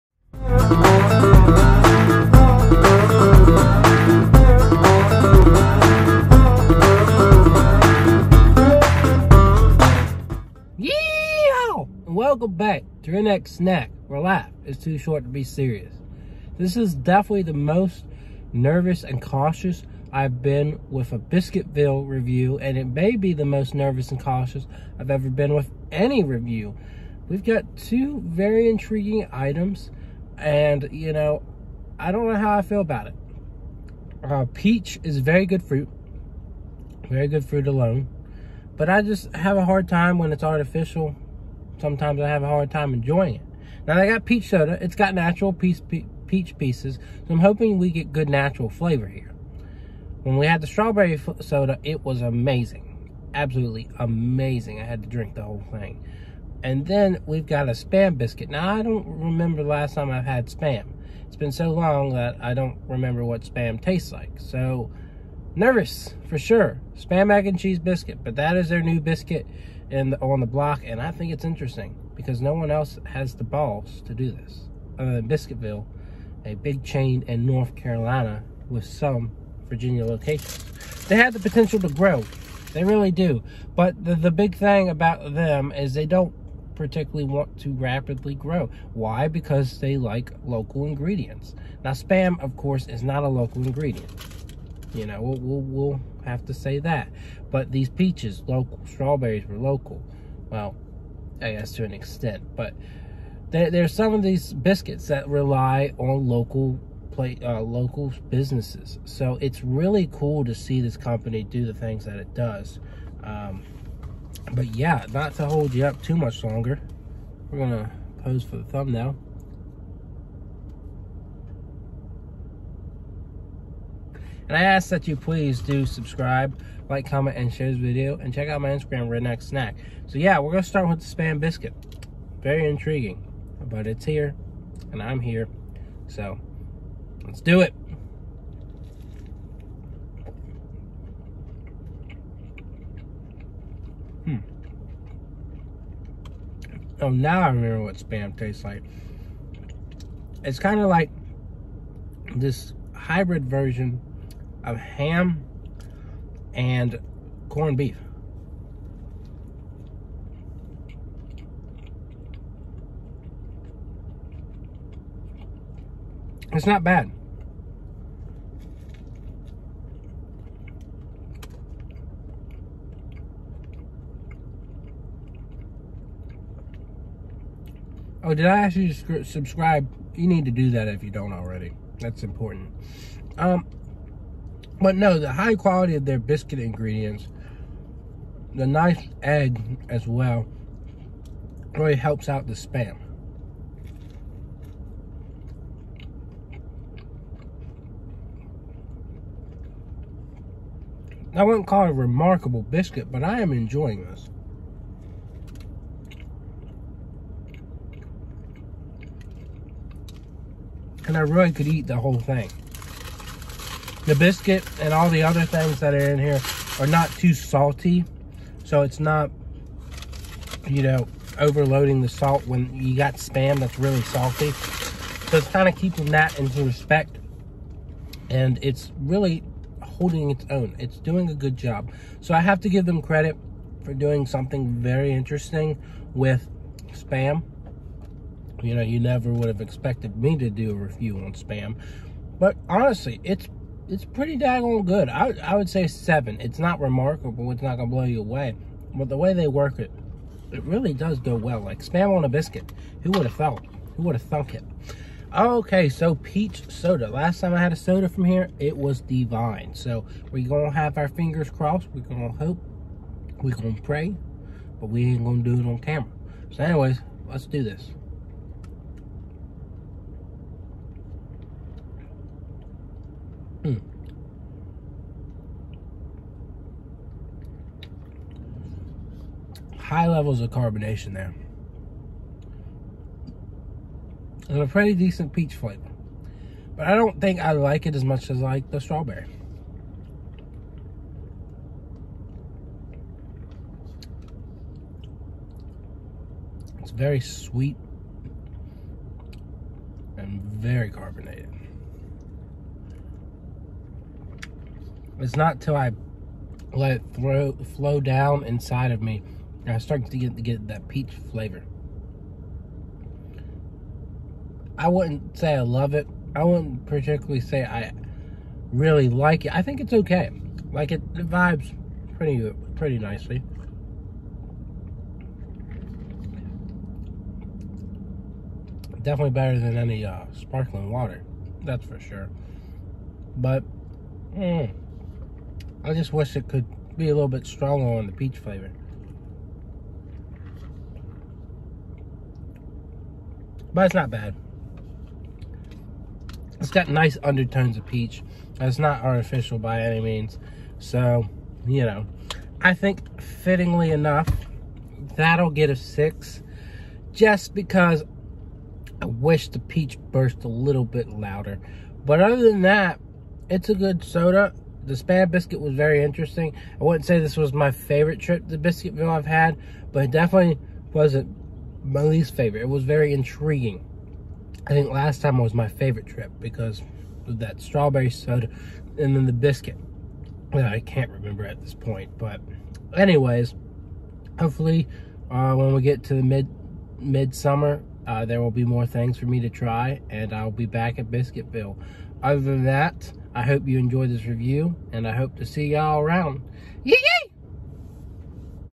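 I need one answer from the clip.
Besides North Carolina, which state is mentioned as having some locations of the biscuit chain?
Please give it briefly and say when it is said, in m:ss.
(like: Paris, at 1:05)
Virginia, at 1:19.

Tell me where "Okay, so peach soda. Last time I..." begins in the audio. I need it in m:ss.
4:15.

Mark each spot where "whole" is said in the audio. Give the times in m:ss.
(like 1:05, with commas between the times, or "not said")
0:55, 3:31.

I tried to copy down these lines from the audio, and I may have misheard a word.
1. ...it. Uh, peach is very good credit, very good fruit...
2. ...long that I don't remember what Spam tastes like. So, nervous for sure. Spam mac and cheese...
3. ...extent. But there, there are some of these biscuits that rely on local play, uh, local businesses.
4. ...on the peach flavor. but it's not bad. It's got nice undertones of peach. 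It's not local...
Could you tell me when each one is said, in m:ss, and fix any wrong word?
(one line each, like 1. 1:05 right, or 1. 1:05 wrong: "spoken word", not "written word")
1. 0:33 wrong: "fruit", not "credit"
2. 1:01 right
3. 1:41 right
4. 5:37 wrong: "artificial", not "local".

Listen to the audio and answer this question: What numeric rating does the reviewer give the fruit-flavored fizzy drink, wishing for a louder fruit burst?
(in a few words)
6.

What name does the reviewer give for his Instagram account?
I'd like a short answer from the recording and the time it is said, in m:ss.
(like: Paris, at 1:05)
Redneck Snack, at 2:09.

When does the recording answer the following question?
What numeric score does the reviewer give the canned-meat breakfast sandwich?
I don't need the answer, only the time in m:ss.
4:05.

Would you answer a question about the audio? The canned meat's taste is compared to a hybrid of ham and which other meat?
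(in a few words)
corned beef.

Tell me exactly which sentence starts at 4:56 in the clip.
It's very sweet and very carbonated.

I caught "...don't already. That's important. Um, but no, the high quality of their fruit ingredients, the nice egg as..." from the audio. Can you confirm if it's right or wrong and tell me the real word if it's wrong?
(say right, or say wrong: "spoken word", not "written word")
wrong: "biscuit", not "fruit".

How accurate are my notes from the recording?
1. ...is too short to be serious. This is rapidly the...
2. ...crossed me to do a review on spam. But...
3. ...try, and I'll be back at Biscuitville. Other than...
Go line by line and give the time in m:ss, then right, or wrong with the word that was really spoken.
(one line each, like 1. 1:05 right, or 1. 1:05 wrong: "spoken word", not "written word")
1. 0:14 wrong: "definitely", not "rapidly"
2. 3:59 wrong: "expected", not "crossed"
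3. 6:29 right.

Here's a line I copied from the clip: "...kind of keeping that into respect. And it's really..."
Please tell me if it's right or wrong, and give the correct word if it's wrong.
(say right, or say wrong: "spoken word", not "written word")
right.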